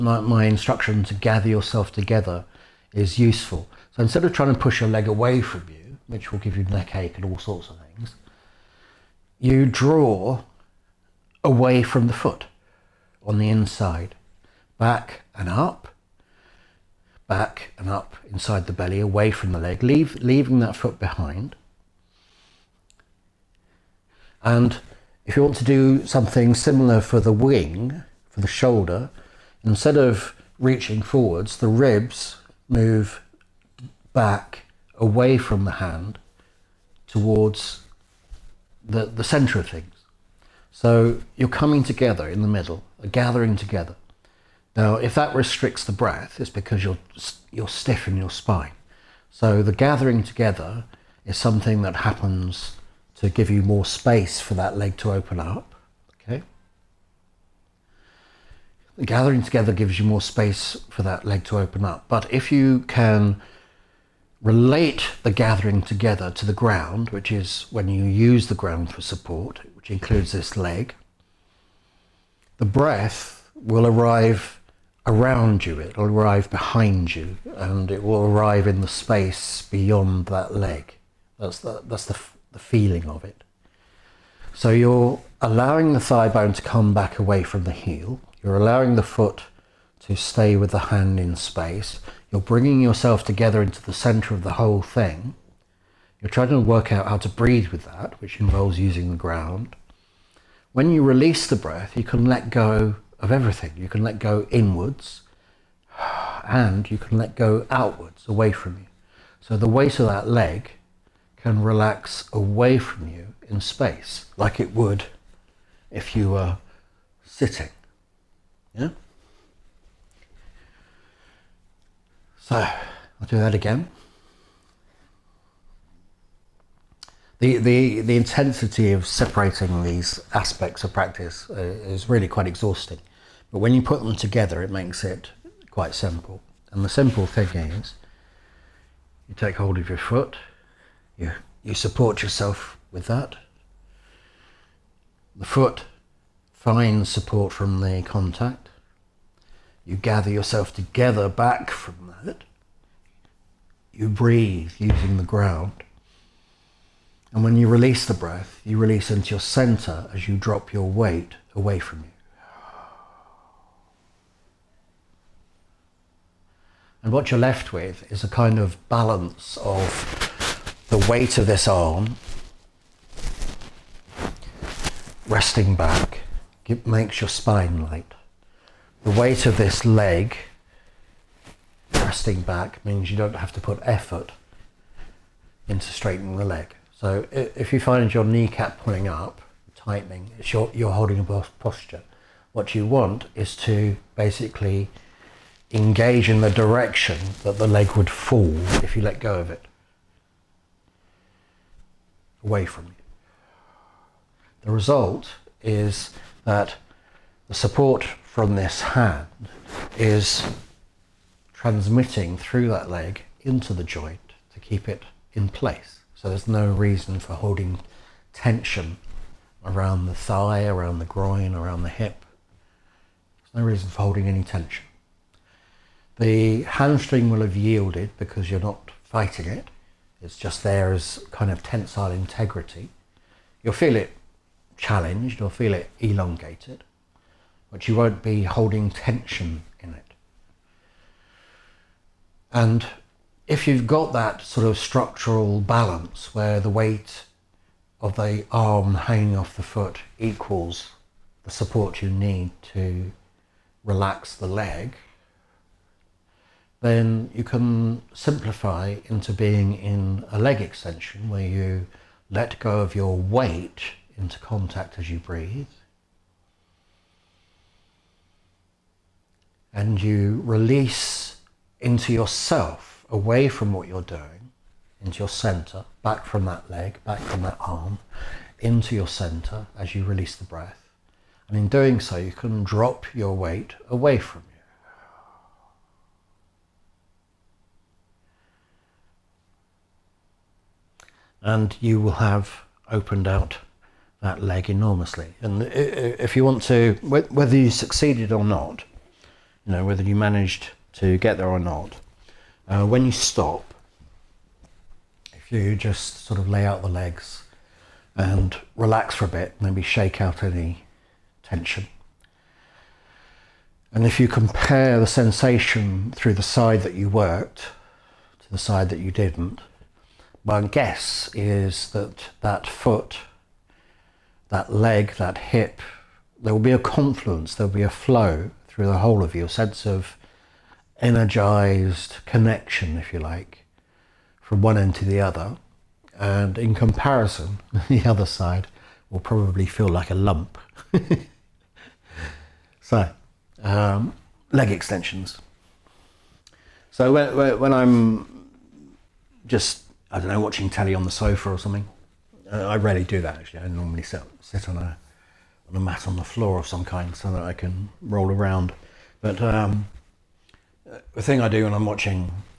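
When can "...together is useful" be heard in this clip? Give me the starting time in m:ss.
0:01.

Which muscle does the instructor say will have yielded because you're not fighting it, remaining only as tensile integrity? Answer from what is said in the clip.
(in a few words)
Hamstring.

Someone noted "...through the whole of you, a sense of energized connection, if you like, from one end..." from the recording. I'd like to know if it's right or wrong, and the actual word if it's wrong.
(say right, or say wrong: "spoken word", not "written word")
right.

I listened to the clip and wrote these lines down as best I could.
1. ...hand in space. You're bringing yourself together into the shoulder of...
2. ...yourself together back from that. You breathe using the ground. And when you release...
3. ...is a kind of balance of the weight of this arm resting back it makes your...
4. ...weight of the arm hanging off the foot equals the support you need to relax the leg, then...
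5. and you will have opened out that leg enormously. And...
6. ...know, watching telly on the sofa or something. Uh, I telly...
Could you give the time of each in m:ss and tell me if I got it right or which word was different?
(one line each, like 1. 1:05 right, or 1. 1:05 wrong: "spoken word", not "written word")
1. 1:30 wrong: "center", not "shoulder"
2. 2:30 right
3. 2:48 right
4. 4:06 right
5. 4:51 right
6. 5:50 wrong: "rarely", not "telly".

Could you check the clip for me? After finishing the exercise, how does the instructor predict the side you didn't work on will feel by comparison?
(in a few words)
Like a lump.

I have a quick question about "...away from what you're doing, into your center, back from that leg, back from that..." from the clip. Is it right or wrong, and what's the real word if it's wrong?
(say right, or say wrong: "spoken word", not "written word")
right.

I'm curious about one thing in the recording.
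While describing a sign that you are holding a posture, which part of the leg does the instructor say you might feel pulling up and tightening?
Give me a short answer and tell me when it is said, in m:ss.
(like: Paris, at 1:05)
Kneecap, at 3:08.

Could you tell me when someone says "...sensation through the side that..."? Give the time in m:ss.
5:15.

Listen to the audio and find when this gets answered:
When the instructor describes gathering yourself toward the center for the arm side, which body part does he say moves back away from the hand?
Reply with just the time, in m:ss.
0:31.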